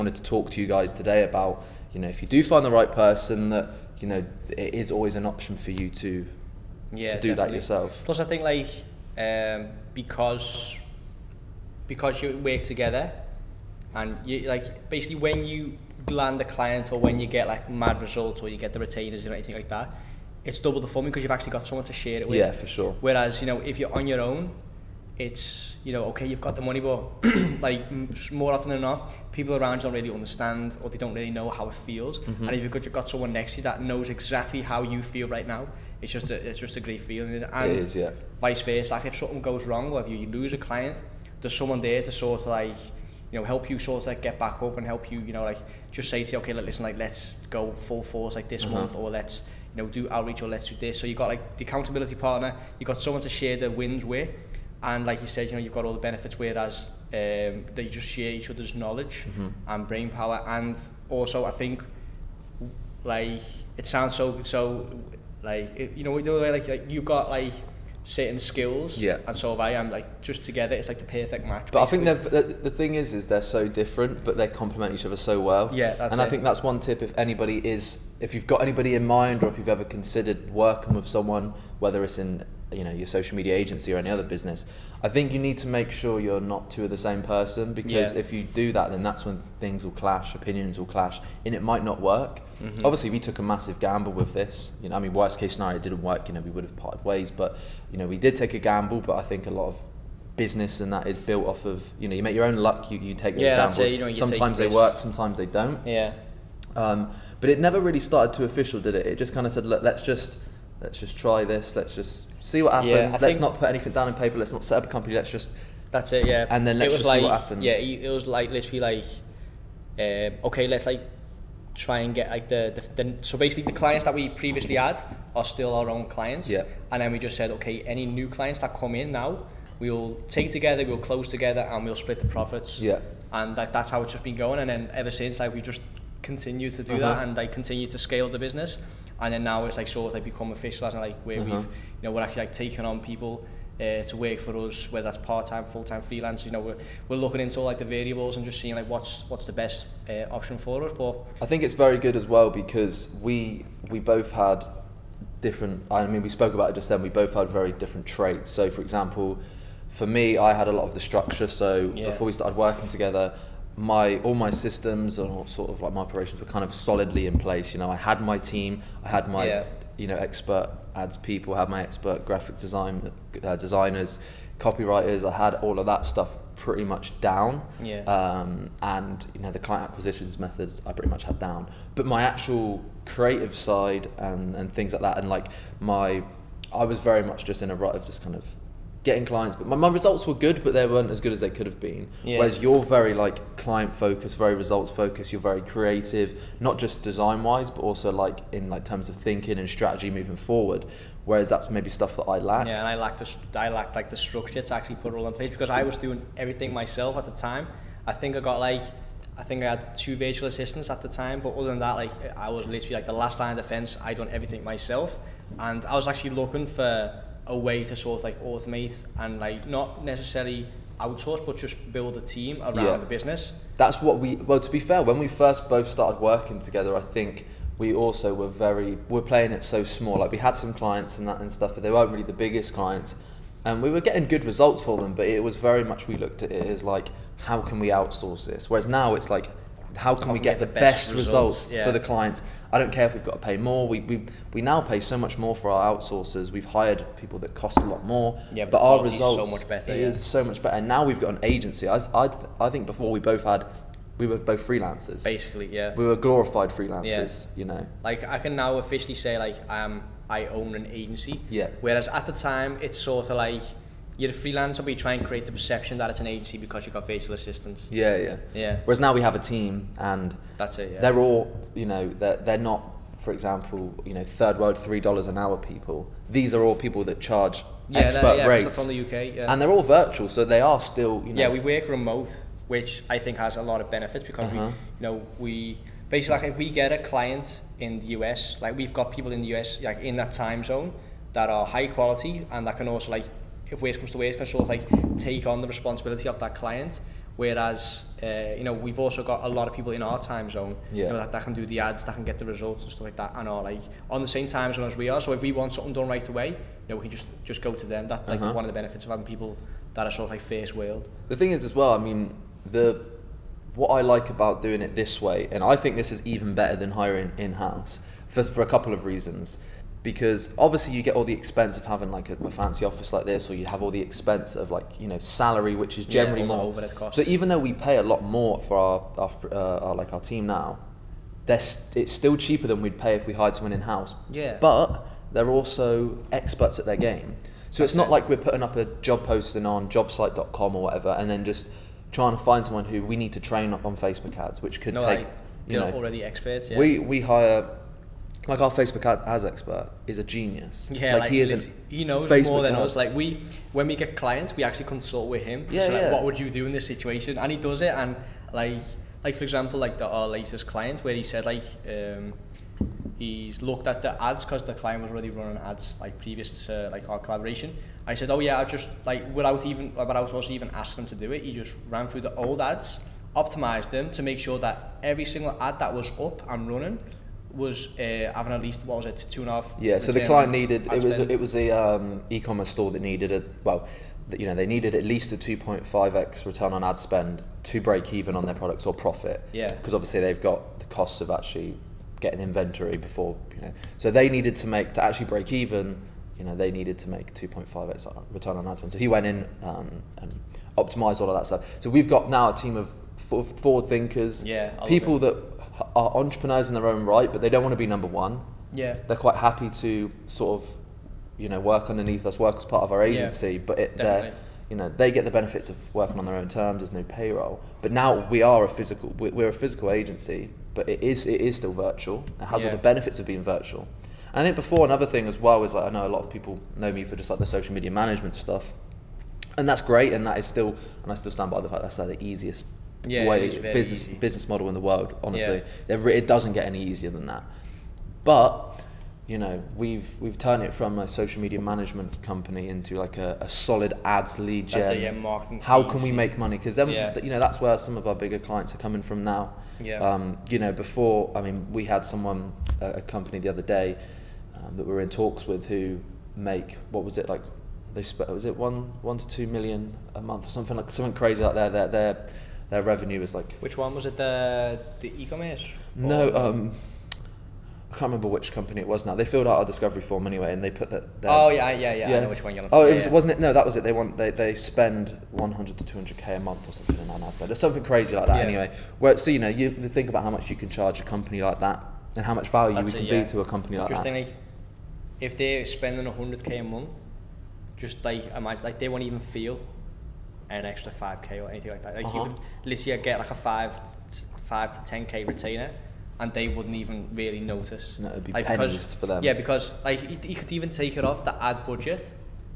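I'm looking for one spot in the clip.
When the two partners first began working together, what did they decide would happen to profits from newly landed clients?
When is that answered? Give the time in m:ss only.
2:11.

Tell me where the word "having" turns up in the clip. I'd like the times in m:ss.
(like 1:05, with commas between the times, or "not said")
5:09, 5:21, 6:18.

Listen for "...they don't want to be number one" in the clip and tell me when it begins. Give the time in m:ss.
6:47.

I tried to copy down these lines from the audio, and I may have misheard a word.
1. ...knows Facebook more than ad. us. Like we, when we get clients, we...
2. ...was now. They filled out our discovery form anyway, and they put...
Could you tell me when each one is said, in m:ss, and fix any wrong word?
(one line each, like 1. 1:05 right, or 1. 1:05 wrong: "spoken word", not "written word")
1. 5:52 right
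2. 7:48 right.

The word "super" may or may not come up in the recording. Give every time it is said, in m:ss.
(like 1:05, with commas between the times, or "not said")
not said.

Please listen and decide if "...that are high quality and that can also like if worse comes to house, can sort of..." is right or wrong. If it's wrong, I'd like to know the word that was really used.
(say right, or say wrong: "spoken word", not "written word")
wrong: "worse", not "house".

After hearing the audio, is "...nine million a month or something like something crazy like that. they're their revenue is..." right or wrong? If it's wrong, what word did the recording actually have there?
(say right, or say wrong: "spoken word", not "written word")
wrong: "two", not "nine".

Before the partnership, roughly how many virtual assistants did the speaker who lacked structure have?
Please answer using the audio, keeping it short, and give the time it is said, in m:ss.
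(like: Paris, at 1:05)
2, at 3:29.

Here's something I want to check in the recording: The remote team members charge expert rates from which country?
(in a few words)
UK.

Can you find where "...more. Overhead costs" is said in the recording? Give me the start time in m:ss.
5:26.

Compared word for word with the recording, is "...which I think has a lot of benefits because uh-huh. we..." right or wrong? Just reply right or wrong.
right.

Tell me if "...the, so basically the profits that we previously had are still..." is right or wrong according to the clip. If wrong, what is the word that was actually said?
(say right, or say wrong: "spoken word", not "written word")
wrong: "clients", not "profits".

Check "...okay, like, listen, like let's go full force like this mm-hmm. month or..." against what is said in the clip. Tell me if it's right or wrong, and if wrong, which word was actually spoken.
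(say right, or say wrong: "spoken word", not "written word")
right.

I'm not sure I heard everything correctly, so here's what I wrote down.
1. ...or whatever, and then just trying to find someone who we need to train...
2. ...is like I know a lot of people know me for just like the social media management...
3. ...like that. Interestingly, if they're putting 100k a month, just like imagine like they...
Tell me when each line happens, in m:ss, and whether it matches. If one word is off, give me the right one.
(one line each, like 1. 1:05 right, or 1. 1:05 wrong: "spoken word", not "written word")
1. 5:40 right
2. 7:05 right
3. 8:03 wrong: "spending", not "putting".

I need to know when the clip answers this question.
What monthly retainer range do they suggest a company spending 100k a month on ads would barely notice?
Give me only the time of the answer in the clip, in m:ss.
8:13.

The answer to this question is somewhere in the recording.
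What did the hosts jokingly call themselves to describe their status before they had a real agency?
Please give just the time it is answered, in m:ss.
4:16.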